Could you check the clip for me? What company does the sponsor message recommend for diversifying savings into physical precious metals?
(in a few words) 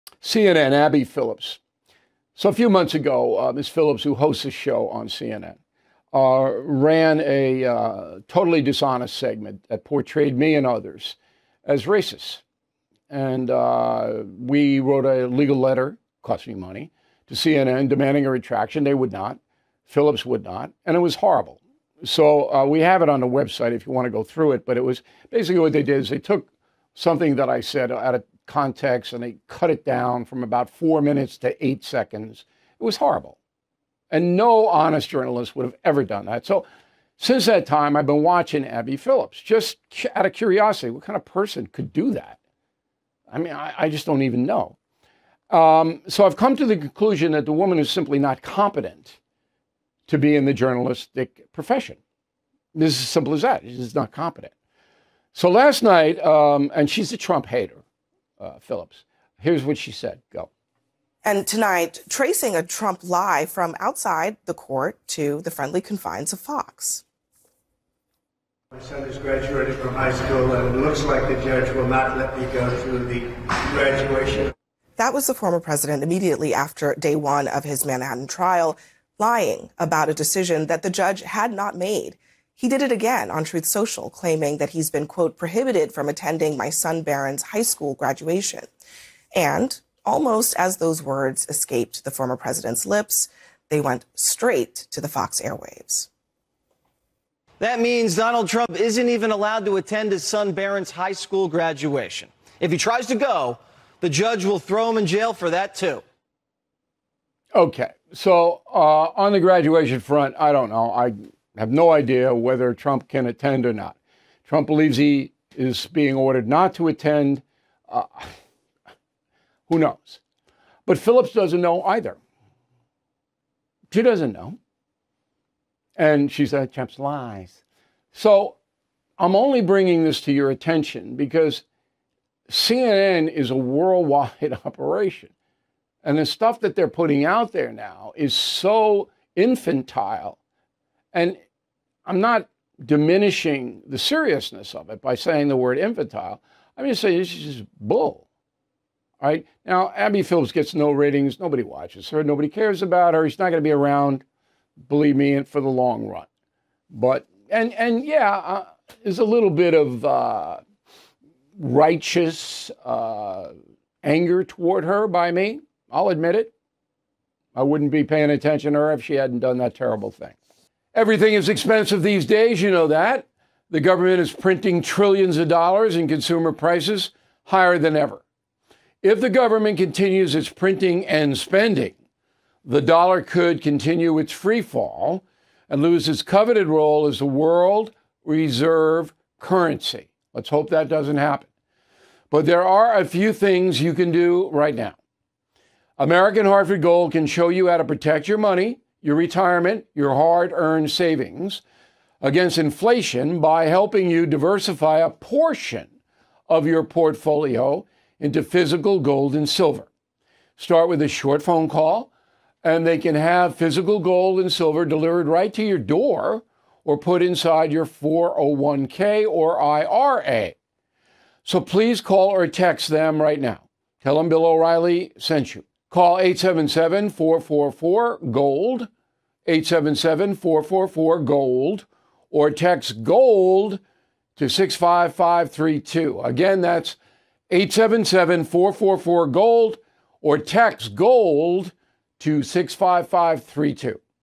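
American Hartford Gold.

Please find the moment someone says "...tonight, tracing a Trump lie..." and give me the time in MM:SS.
01:01.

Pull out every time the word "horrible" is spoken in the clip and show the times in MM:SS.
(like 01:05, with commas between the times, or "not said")
00:21, 00:32.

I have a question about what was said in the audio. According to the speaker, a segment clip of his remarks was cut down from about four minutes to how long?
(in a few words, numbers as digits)
8 seconds.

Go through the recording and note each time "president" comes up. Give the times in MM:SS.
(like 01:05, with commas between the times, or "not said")
01:15, 01:32.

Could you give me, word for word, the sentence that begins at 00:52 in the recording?
This is as simple as that.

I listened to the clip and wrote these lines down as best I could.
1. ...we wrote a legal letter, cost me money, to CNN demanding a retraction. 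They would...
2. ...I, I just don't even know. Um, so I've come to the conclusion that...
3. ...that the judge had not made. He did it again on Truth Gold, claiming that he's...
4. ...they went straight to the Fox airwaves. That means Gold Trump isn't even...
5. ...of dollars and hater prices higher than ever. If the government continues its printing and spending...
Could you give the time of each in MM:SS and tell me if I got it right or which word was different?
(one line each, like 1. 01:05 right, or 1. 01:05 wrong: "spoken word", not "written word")
1. 00:14 right
2. 00:43 right
3. 01:20 wrong: "Social", not "Gold"
4. 01:33 wrong: "Donald", not "Gold"
5. 02:55 wrong: "consumer", not "hater".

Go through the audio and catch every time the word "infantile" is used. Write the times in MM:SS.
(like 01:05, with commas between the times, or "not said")
02:19, 02:25.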